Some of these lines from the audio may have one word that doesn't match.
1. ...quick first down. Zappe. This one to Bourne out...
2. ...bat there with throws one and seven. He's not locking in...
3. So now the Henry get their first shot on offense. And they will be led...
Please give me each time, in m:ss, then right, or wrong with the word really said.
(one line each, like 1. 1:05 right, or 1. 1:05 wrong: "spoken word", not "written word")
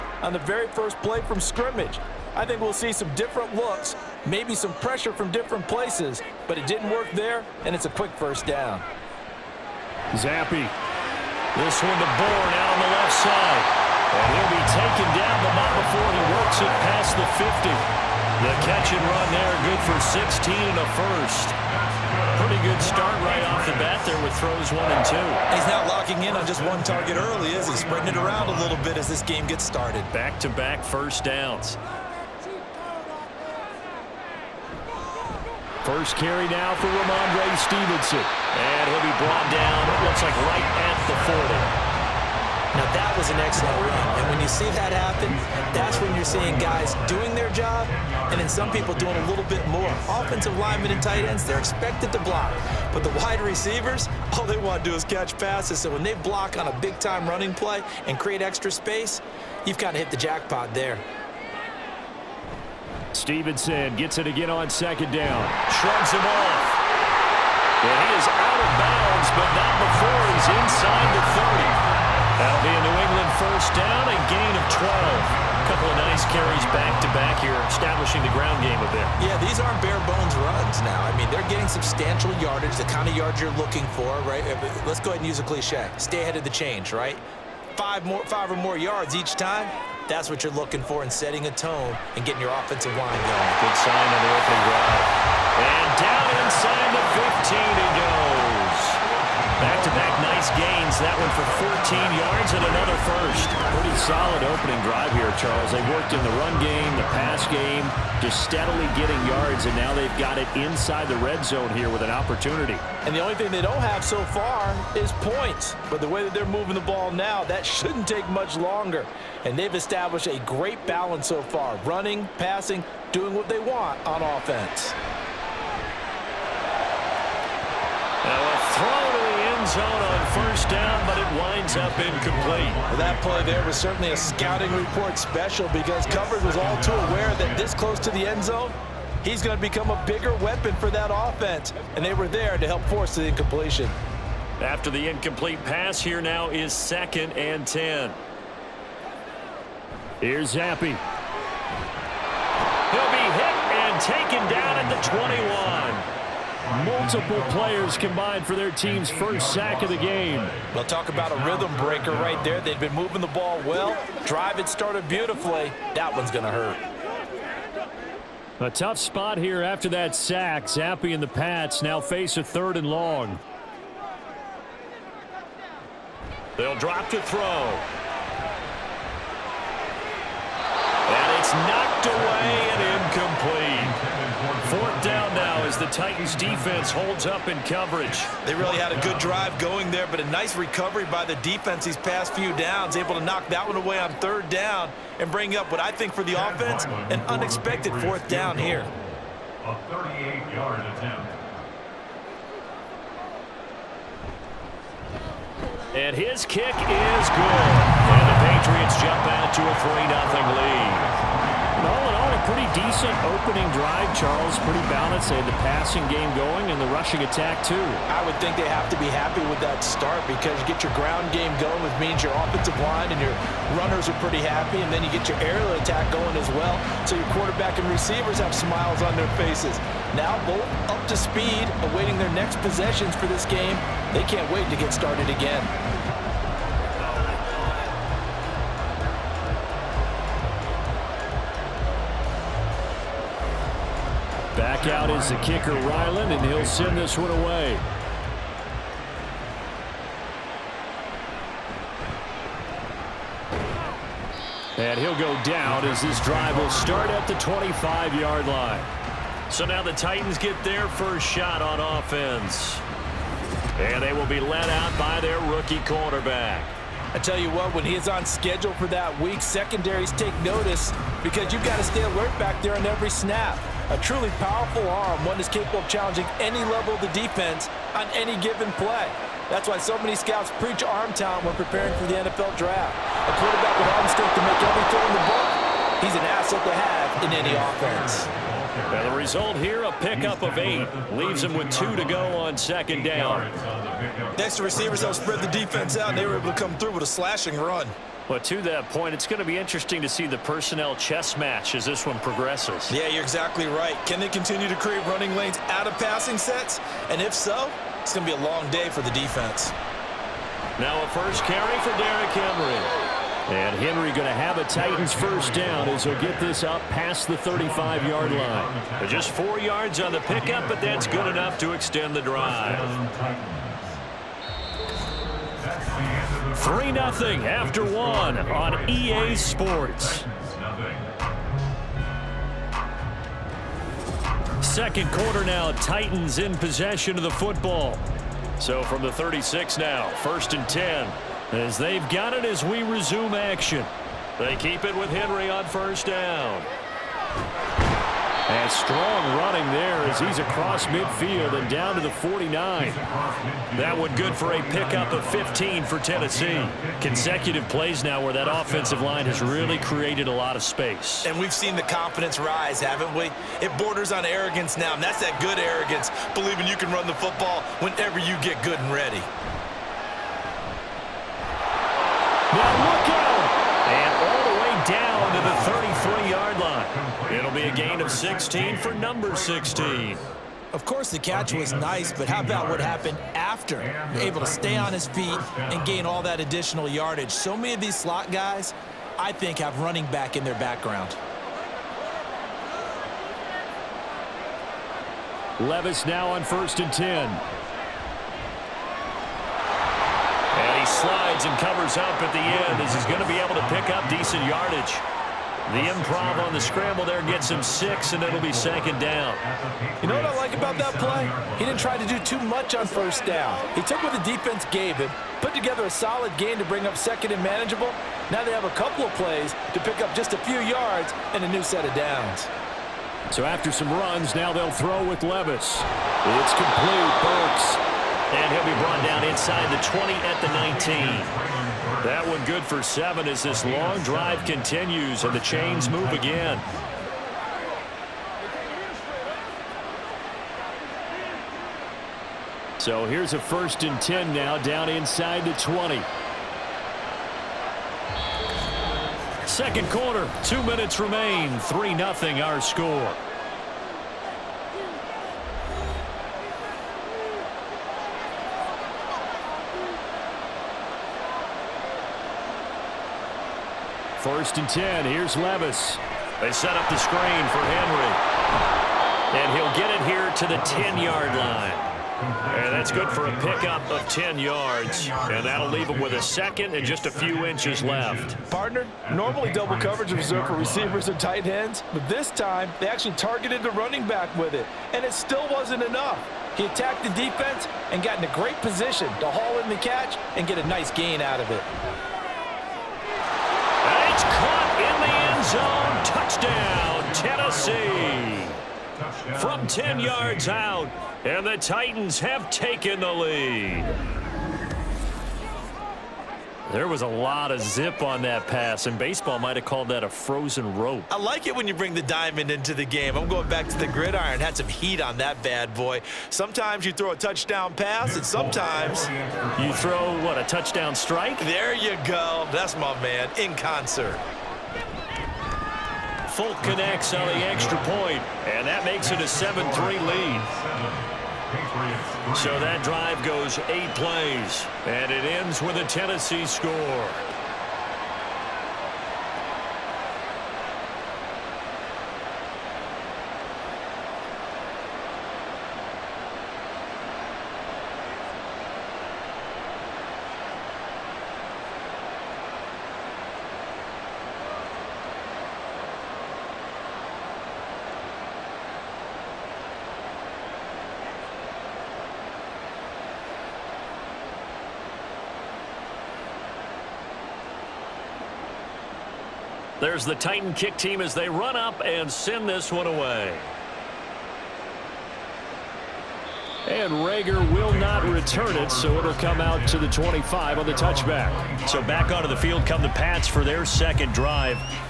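1. 0:07 right
2. 0:23 wrong: "two", not "seven"
3. 4:19 wrong: "Titans", not "Henry".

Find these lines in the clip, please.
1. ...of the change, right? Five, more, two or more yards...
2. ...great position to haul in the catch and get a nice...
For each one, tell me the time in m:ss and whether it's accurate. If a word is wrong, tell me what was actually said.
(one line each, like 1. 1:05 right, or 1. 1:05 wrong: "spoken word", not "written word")
1. 1:26 wrong: "five", not "two"
2. 8:08 right.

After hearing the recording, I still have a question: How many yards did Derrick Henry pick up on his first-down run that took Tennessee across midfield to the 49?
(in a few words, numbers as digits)
15.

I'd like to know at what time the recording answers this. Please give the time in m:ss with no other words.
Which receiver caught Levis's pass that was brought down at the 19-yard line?
7:07.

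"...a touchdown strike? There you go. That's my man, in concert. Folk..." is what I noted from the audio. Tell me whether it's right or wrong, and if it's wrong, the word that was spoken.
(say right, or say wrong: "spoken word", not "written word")
right.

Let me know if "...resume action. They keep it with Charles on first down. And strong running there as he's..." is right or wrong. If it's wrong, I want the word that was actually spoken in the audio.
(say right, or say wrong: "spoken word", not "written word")
wrong: "Henry", not "Charles".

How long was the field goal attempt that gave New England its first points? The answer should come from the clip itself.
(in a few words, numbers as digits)
38 yards.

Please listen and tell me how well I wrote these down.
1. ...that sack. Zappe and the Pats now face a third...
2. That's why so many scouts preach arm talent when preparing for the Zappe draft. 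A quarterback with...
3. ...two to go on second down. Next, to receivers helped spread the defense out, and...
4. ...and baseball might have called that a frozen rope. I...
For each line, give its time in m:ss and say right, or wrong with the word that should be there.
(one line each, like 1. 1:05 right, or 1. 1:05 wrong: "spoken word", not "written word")
1. 2:49 right
2. 4:39 wrong: "NFL", not "Zappe"
3. 4:51 right
4. 8:28 right.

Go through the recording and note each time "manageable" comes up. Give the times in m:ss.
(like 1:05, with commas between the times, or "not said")
6:57.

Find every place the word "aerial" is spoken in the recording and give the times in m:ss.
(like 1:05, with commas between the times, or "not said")
3:45.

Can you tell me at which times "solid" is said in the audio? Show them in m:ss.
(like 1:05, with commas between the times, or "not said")
1:43, 6:55.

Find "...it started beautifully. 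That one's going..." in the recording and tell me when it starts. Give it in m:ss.
2:44.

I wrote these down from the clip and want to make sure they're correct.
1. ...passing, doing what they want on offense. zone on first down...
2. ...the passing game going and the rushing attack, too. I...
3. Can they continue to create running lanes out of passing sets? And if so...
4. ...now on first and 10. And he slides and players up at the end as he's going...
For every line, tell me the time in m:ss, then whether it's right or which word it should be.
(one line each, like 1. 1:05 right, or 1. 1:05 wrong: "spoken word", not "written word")
1. 2:02 right
2. 3:35 right
3. 5:04 right
4. 6:36 wrong: "covers", not "players".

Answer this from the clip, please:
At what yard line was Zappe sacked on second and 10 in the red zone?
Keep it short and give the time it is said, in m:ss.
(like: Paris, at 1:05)
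21, at 2:35.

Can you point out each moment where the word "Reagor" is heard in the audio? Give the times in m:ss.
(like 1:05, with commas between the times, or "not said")
9:37.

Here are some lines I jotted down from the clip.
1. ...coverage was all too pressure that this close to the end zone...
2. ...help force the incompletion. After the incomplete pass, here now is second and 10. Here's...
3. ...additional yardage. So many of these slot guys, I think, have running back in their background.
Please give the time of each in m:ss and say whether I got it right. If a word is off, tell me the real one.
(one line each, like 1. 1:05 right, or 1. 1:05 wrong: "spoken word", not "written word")
1. 2:16 wrong: "aware", not "pressure"
2. 2:22 right
3. 6:26 right.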